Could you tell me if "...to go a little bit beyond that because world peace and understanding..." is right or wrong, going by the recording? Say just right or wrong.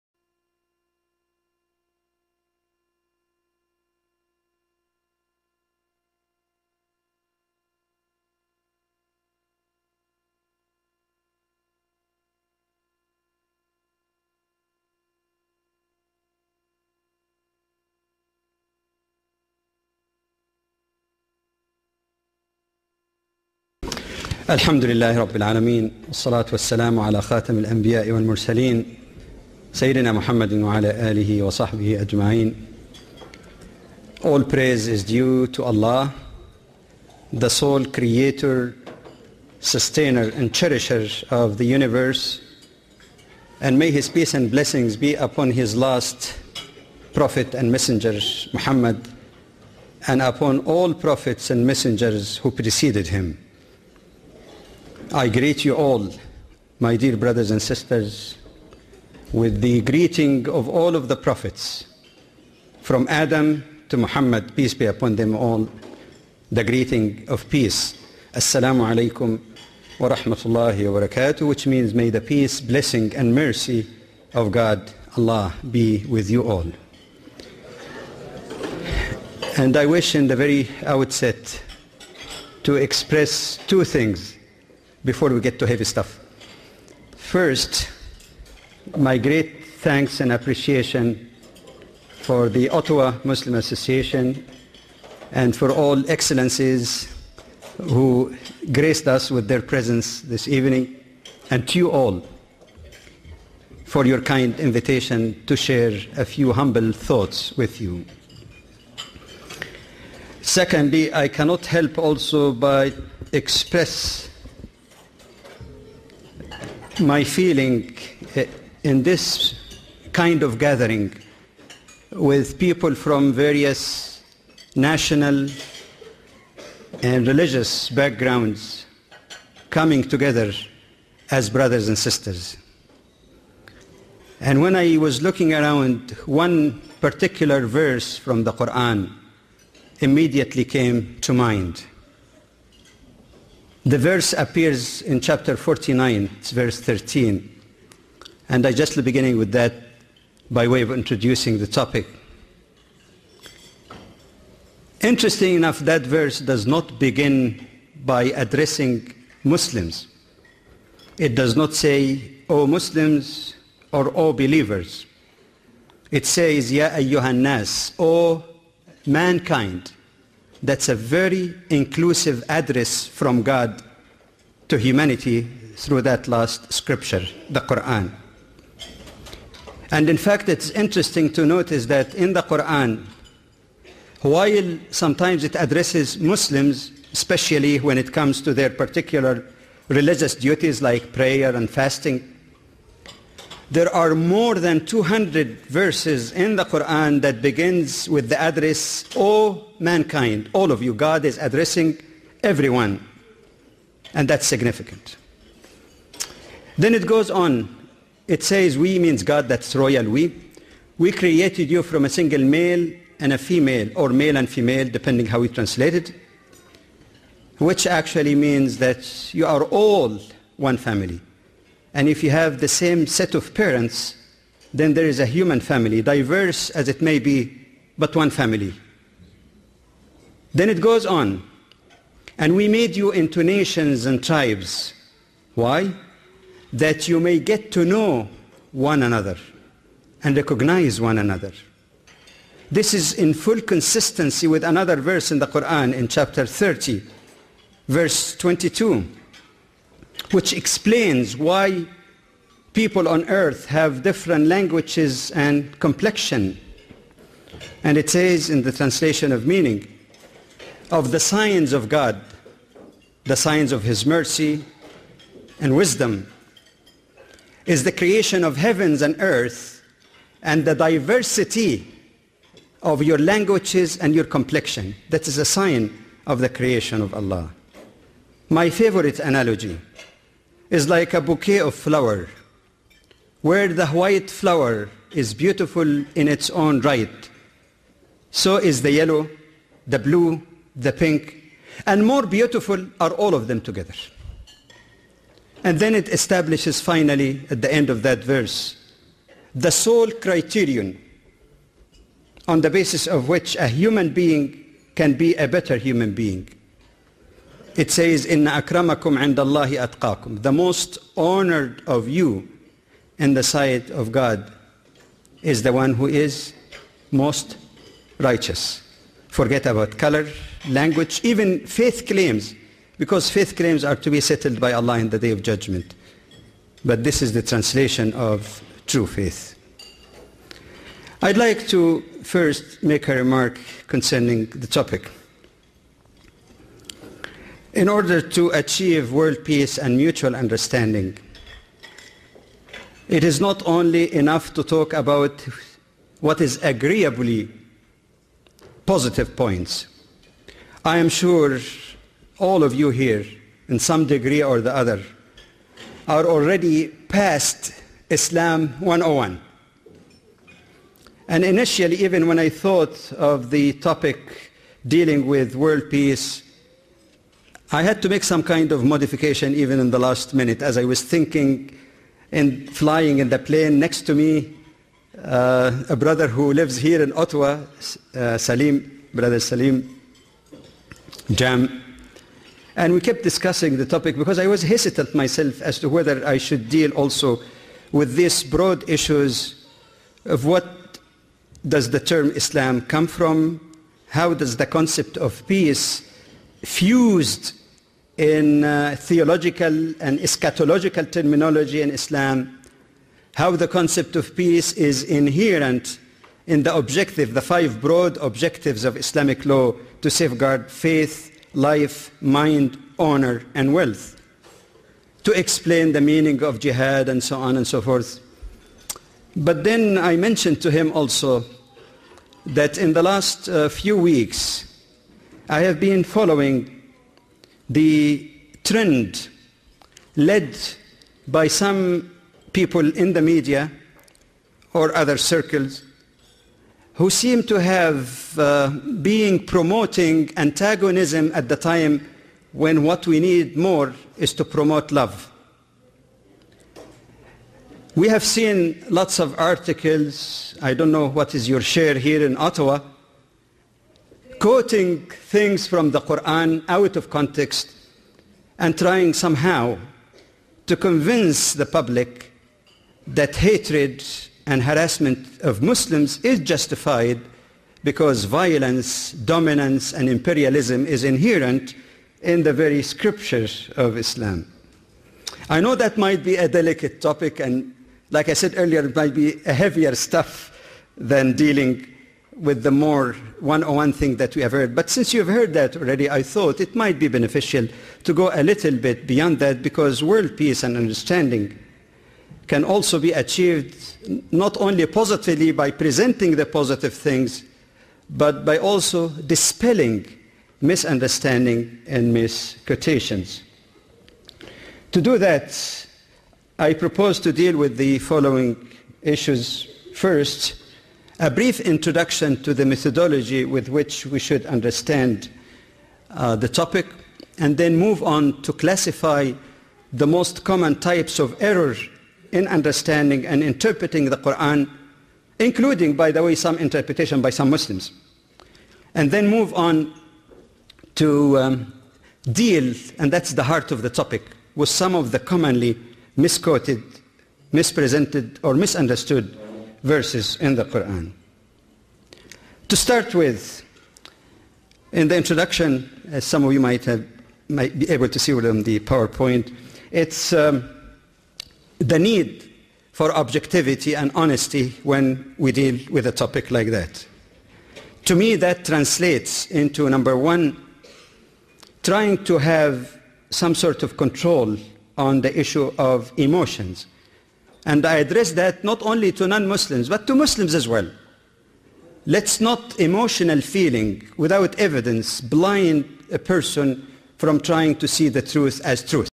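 right.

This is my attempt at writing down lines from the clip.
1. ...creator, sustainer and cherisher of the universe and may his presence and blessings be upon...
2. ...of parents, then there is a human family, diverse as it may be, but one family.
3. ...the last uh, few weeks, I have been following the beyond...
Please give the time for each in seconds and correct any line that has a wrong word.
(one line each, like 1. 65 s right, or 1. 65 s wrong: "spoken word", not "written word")
1. 37 s wrong: "peace", not "presence"
2. 223 s right
3. 422 s wrong: "trend", not "beyond".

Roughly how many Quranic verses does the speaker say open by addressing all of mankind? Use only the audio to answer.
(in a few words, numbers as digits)
More than 200.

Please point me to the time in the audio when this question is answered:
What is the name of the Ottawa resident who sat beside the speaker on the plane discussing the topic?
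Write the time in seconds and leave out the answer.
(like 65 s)
379 s.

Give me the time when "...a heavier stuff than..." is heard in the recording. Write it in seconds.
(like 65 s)
479 s.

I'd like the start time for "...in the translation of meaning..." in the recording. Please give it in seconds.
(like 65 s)
258 s.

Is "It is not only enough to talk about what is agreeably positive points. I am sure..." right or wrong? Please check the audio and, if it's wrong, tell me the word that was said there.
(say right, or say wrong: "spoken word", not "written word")
right.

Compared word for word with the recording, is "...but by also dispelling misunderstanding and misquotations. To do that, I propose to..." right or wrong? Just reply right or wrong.
right.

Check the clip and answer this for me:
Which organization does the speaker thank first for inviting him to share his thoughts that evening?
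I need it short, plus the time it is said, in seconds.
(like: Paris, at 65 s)
Ottawa Muslim Association, at 92 s.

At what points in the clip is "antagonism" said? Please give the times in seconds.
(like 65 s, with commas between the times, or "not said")
440 s.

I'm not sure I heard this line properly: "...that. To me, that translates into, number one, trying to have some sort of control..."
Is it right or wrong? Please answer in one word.
right.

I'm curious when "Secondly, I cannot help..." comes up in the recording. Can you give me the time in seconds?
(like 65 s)
110 s.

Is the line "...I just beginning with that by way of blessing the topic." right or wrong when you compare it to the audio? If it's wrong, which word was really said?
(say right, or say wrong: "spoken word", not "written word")
wrong: "introducing", not "blessing".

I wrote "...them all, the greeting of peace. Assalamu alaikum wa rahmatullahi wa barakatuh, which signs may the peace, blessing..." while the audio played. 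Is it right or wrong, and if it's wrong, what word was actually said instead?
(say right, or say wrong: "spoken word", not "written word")
wrong: "means", not "signs".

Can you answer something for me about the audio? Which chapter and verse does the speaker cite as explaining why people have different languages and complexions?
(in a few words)
Chapter 30, verse 22.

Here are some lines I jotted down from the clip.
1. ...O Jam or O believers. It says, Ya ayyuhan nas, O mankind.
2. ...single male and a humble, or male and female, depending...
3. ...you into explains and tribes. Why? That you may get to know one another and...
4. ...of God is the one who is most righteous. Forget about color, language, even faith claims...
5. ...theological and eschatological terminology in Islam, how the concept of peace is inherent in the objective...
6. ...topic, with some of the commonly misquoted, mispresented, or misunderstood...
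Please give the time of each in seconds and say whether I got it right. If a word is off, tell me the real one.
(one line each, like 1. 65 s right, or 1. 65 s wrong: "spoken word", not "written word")
1. 162 s wrong: "Muslims", not "Jam"
2. 212 s wrong: "female", not "humble"
3. 232 s wrong: "nations", not "explains"
4. 313 s right
5. 398 s right
6. 533 s right.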